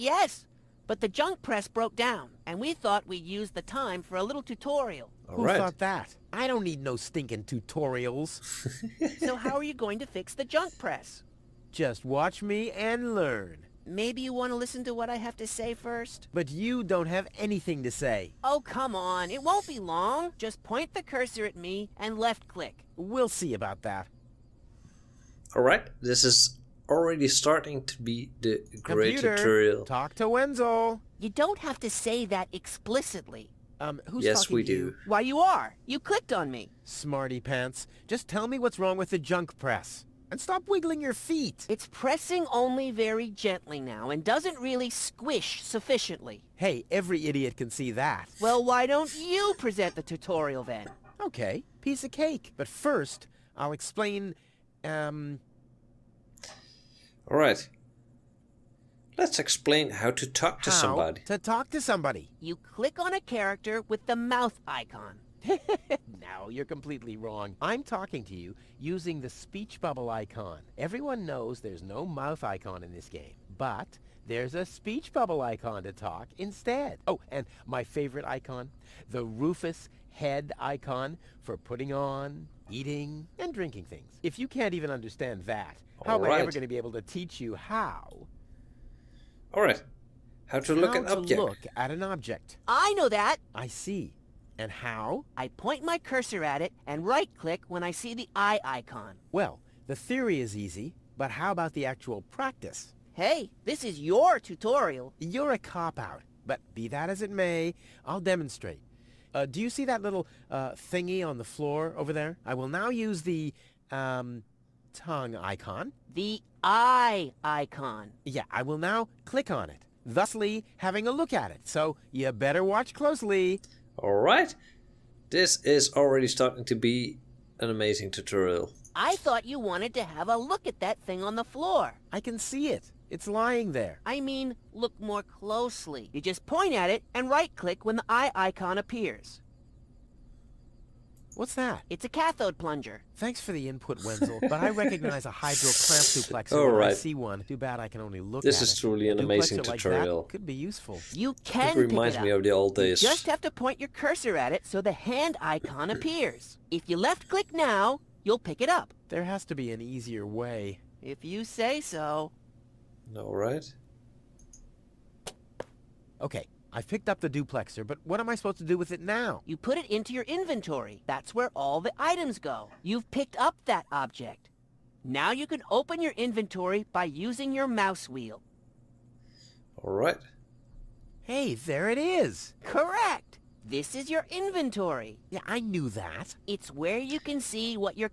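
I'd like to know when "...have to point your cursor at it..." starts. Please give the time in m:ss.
2:33.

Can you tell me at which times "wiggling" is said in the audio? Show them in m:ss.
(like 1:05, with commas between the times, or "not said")
0:40.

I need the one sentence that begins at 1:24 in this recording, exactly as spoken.
If you can't even understand that, All how right.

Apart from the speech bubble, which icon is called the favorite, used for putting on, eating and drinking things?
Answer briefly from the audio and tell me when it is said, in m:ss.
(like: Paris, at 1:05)
Rufus head icon, at 1:19.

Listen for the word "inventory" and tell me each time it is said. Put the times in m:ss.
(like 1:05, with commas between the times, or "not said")
2:50, 2:56, 3:04.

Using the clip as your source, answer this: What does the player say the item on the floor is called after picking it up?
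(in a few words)
Duplexer.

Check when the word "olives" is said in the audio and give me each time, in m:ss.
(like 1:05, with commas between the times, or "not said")
not said.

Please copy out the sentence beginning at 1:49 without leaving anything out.
Uh, do you see that little uh, thingy on the floor over there?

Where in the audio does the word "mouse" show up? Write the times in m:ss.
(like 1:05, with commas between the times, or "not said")
2:57.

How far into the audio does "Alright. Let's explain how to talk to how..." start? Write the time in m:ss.
0:57.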